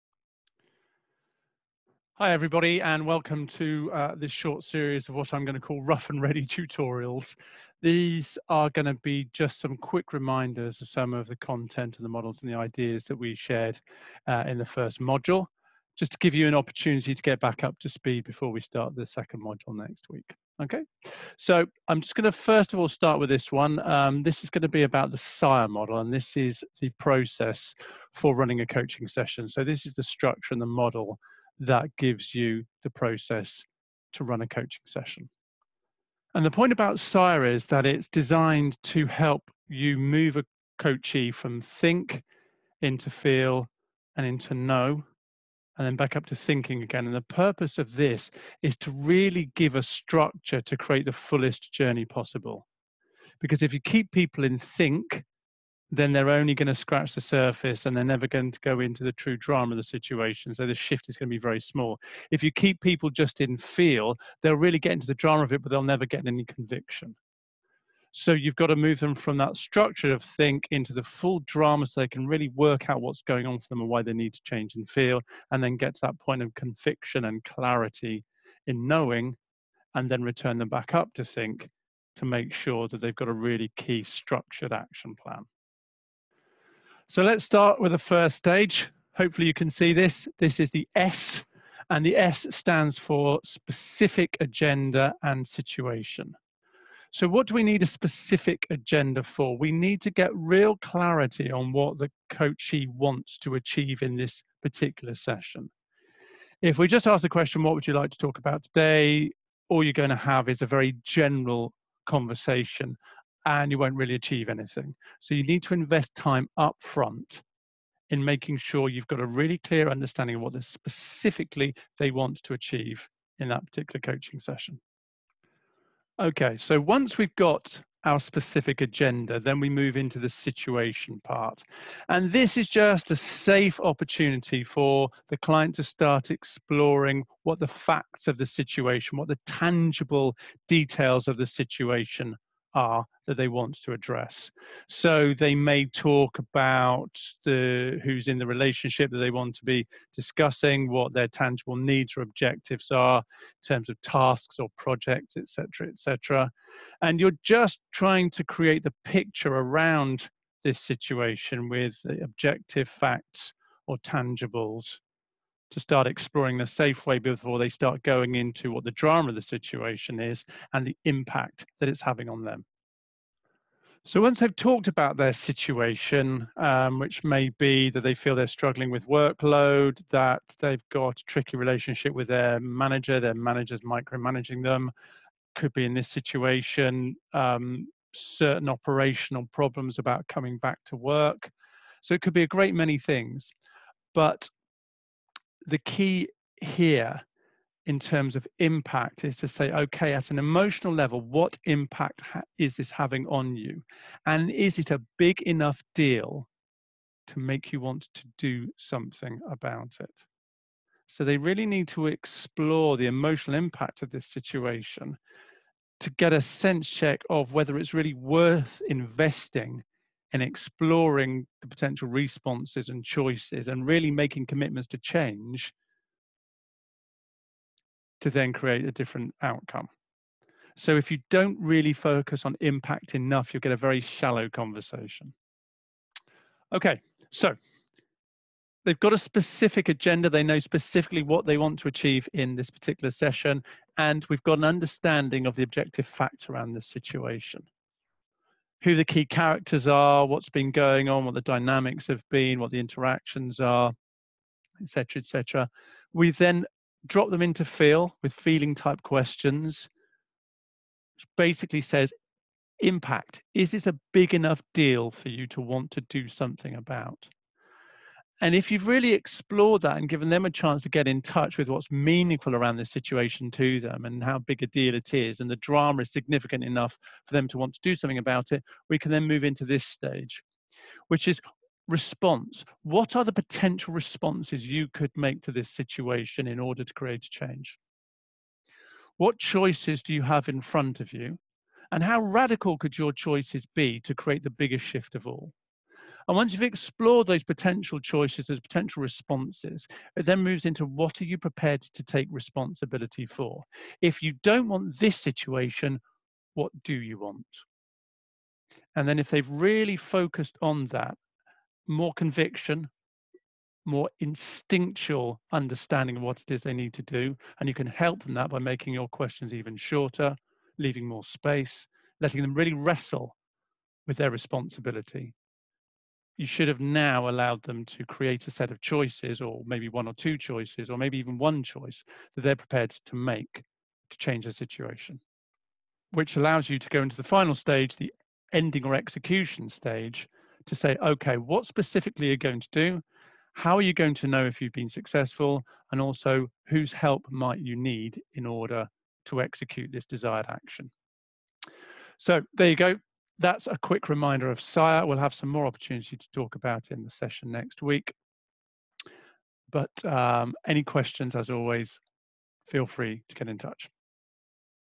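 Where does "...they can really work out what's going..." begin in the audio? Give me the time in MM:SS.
01:12.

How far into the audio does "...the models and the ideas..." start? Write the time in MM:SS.
00:12.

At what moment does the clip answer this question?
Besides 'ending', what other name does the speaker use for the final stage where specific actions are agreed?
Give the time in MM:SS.
05:38.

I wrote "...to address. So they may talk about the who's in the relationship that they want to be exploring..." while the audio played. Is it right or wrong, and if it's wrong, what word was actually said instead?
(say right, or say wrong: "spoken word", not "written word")
wrong: "discussing", not "exploring".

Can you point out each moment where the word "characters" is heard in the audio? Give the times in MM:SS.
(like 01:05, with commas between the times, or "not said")
04:09.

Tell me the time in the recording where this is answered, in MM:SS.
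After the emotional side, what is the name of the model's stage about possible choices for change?
04:41.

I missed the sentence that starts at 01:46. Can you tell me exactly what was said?
If we just ask the question, what would you like to talk about today?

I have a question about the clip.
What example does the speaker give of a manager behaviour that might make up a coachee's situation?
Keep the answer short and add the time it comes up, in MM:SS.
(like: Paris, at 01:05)
micromanaging, at 03:03.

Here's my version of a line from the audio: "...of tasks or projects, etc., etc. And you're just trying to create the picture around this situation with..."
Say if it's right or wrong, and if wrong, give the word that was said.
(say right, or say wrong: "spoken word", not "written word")
right.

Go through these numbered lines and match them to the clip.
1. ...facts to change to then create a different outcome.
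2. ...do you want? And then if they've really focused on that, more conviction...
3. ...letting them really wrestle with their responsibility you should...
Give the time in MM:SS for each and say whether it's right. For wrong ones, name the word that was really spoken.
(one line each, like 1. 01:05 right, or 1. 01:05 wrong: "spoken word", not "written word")
1. 03:44 wrong: "commitments", not "facts"
2. 05:06 right
3. 05:22 right.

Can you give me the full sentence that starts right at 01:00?
So the shift is going to be very small.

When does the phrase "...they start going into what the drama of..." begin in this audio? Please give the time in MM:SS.
02:47.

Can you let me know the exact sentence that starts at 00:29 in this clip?
So this is the structure and the model that gives you the process to run a coaching session.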